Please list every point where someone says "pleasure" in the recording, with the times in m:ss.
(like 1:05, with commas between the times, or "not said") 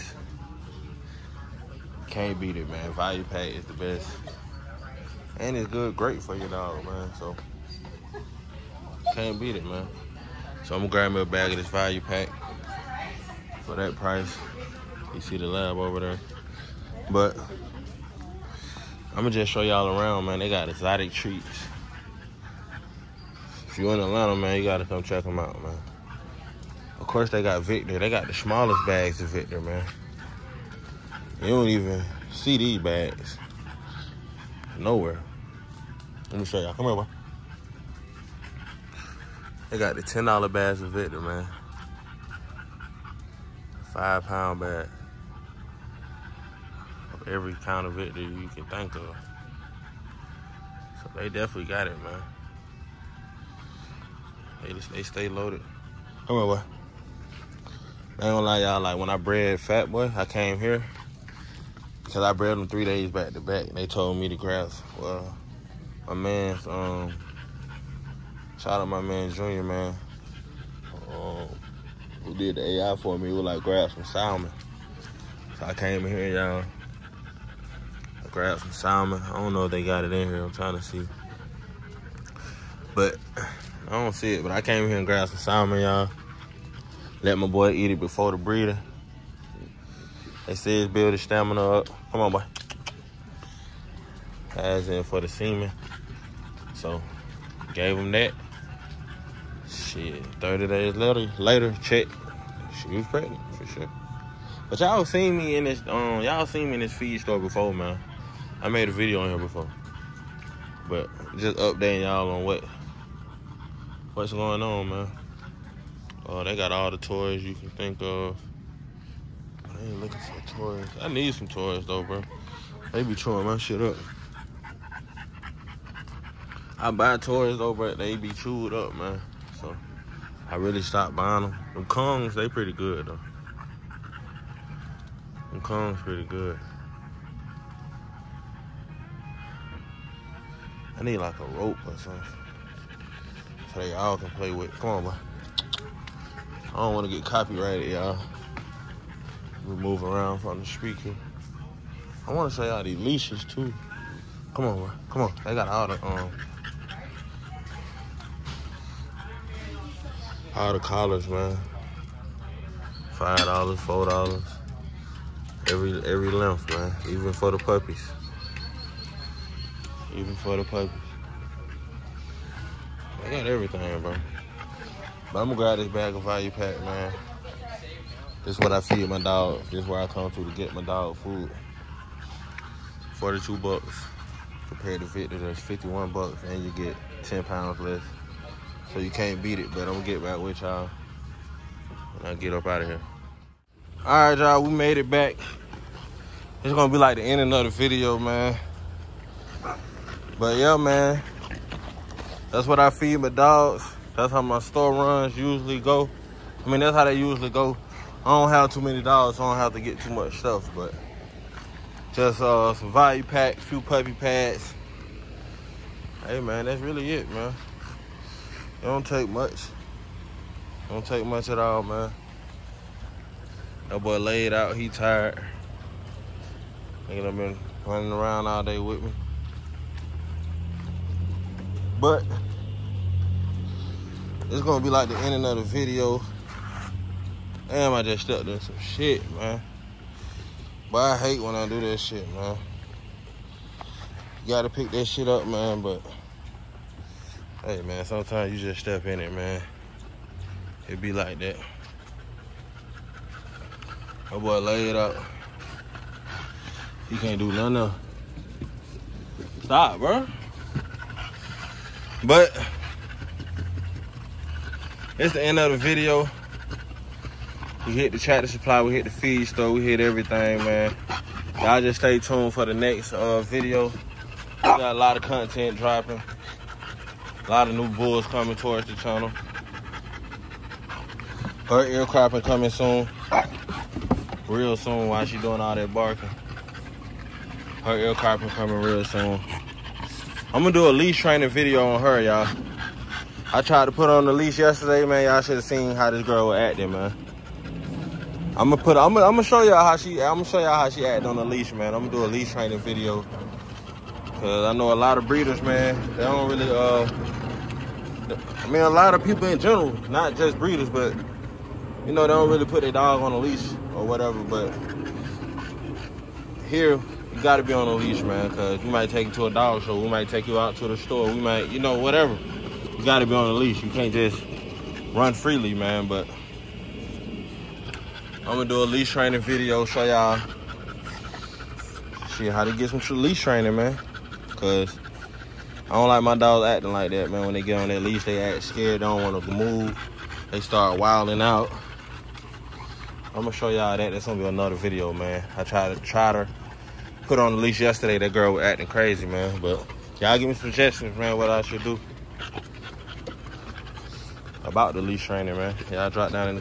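not said.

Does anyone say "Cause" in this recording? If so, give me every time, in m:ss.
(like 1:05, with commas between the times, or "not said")
1:02, 5:04, 5:18, 5:34.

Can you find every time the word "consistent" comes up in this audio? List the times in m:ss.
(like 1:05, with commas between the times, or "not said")
not said.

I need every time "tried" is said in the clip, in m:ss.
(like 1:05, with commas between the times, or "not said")
4:53, 5:45.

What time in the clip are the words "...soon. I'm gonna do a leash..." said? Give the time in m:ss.
4:49.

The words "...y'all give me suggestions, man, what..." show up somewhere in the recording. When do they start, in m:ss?
5:50.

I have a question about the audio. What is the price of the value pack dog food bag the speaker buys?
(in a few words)
$42.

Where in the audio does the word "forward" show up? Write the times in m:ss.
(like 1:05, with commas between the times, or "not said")
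not said.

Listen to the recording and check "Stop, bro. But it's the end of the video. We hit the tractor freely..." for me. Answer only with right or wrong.
wrong.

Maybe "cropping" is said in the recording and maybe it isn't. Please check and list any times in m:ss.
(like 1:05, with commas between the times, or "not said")
4:42, 4:48.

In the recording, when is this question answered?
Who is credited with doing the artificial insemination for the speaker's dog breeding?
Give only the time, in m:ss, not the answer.
1:09.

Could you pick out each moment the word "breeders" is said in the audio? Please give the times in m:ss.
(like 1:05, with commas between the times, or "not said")
1:28, 5:05, 5:10.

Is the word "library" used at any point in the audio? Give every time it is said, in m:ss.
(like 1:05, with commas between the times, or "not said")
not said.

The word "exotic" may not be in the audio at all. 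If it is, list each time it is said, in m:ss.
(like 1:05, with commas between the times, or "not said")
0:20.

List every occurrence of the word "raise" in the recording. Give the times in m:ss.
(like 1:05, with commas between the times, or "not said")
not said.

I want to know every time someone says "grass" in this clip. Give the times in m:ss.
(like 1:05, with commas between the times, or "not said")
1:04, 1:13.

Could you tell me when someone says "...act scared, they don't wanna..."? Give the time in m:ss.
5:38.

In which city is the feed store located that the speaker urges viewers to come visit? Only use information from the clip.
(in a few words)
Atlanta.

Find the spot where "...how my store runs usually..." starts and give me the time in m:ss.
3:24.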